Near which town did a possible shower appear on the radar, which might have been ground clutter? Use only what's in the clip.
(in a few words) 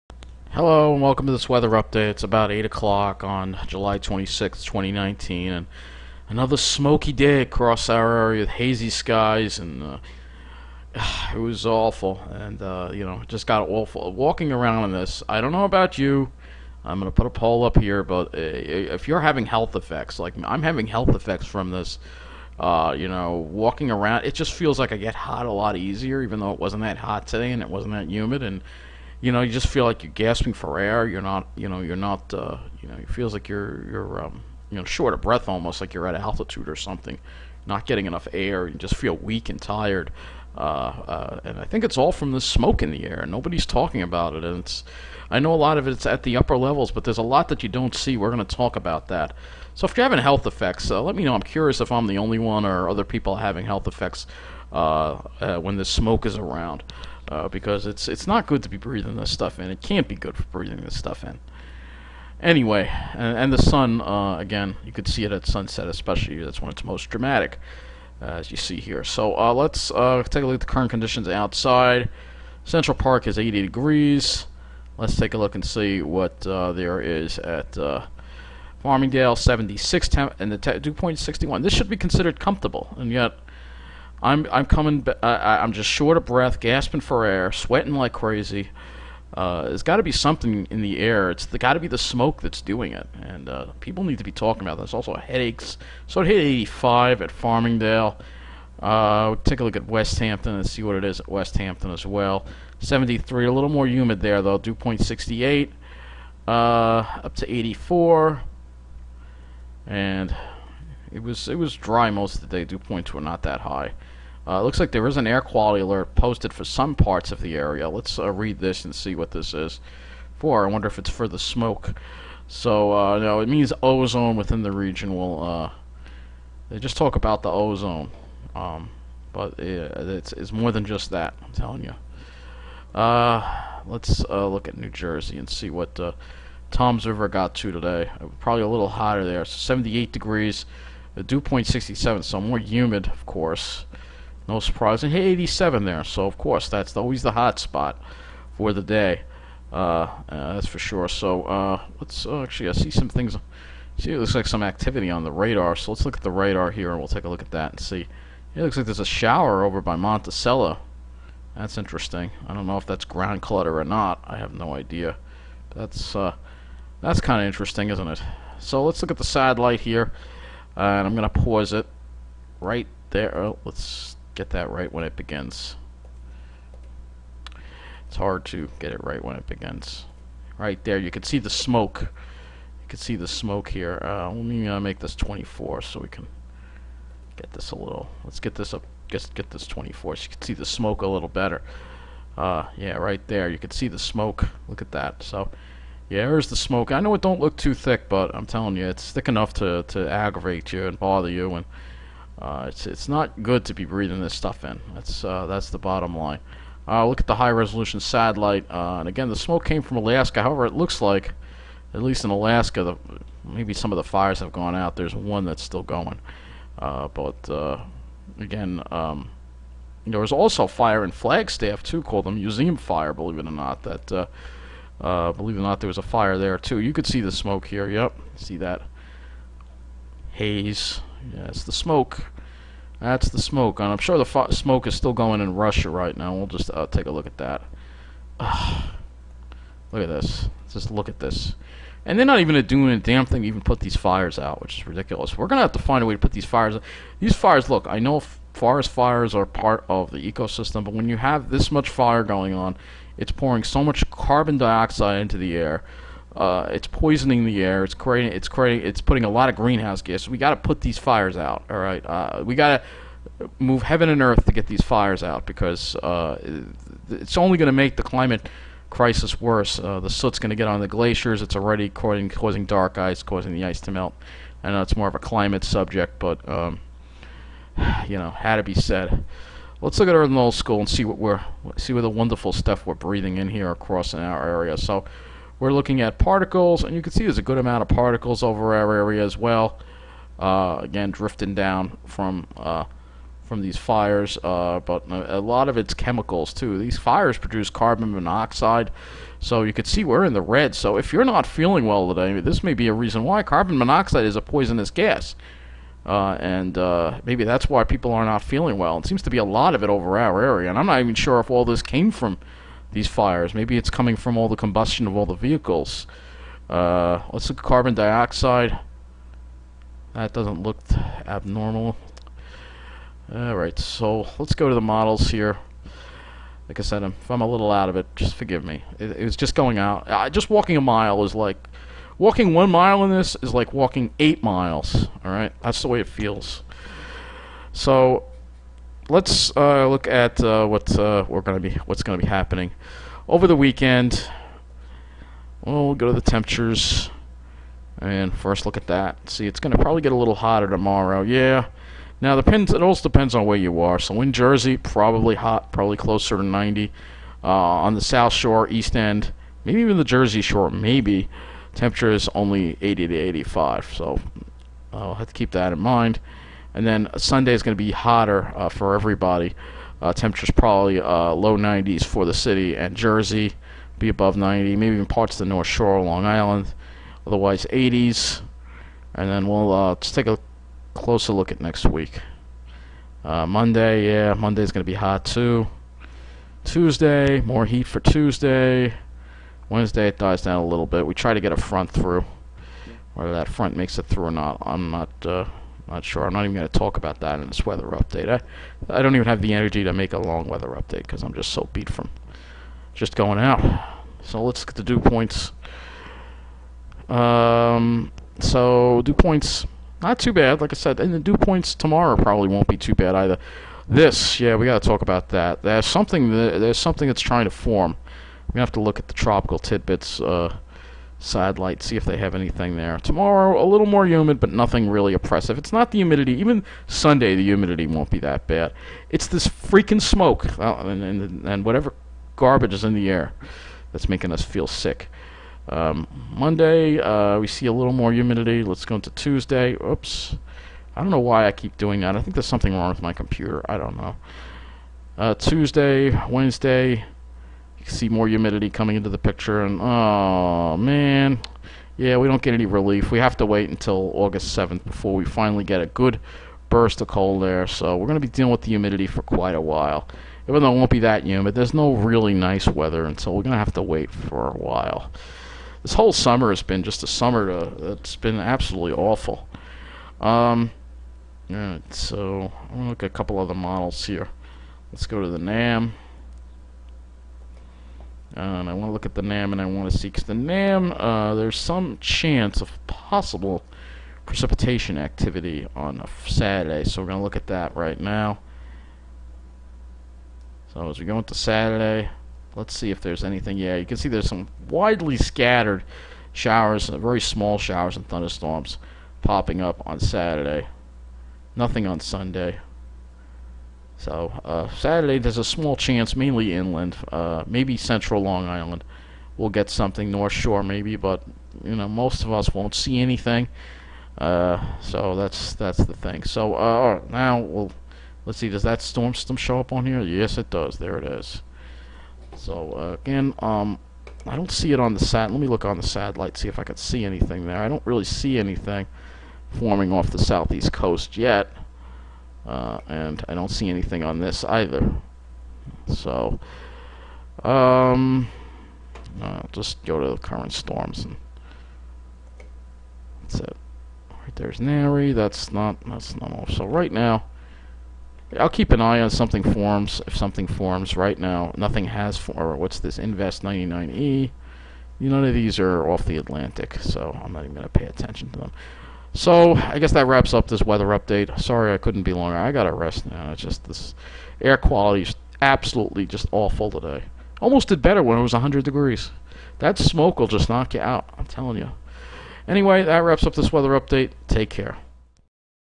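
Monticello.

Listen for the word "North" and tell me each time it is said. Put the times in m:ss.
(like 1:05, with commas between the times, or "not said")
6:15, 8:30.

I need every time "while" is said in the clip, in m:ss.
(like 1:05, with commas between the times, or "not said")
7:39, 7:44.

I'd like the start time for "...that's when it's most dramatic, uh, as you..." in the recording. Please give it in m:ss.
1:06.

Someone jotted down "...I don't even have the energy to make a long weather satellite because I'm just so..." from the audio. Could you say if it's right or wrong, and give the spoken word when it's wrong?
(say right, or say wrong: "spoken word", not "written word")
wrong: "update", not "satellite".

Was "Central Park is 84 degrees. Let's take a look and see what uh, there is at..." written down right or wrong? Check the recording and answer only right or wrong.
wrong.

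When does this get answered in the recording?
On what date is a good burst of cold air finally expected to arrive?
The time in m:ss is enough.
7:34.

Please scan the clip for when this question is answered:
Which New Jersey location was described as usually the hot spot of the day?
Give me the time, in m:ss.
2:16.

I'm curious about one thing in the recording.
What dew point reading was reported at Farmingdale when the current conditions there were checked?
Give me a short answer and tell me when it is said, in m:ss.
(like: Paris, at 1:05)
61, at 1:20.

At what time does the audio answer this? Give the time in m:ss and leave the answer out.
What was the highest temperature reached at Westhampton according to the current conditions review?
1:46.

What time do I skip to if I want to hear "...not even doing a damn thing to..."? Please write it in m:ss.
4:02.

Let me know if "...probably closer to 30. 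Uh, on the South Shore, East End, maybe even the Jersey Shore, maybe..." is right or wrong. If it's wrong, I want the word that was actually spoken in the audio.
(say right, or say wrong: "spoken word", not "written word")
wrong: "90", not "30".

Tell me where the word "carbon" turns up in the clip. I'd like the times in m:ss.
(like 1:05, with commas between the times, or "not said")
4:14, 4:57, 5:03, 5:17.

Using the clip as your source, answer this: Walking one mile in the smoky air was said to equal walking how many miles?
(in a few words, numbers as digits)
8.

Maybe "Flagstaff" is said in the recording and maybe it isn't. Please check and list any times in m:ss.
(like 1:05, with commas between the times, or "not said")
3:41.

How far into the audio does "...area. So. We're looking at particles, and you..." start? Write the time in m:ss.
4:44.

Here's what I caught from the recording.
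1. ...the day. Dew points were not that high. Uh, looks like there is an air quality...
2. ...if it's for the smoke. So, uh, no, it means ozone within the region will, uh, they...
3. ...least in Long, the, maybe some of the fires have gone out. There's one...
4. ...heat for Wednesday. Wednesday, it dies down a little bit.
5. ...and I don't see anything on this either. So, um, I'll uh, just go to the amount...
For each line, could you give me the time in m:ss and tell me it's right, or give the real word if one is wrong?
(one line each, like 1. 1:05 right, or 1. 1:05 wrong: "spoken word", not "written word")
1. 1:52 right
2. 2:00 right
3. 3:32 wrong: "Alaska", not "Long"
4. 6:27 wrong: "Tuesday", not "Wednesday"
5. 8:52 wrong: "current", not "amount".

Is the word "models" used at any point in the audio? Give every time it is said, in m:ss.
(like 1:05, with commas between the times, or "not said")
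5:24, 7:53.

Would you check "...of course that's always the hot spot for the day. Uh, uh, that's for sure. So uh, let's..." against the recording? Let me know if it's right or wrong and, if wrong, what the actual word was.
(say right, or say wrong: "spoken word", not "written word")
right.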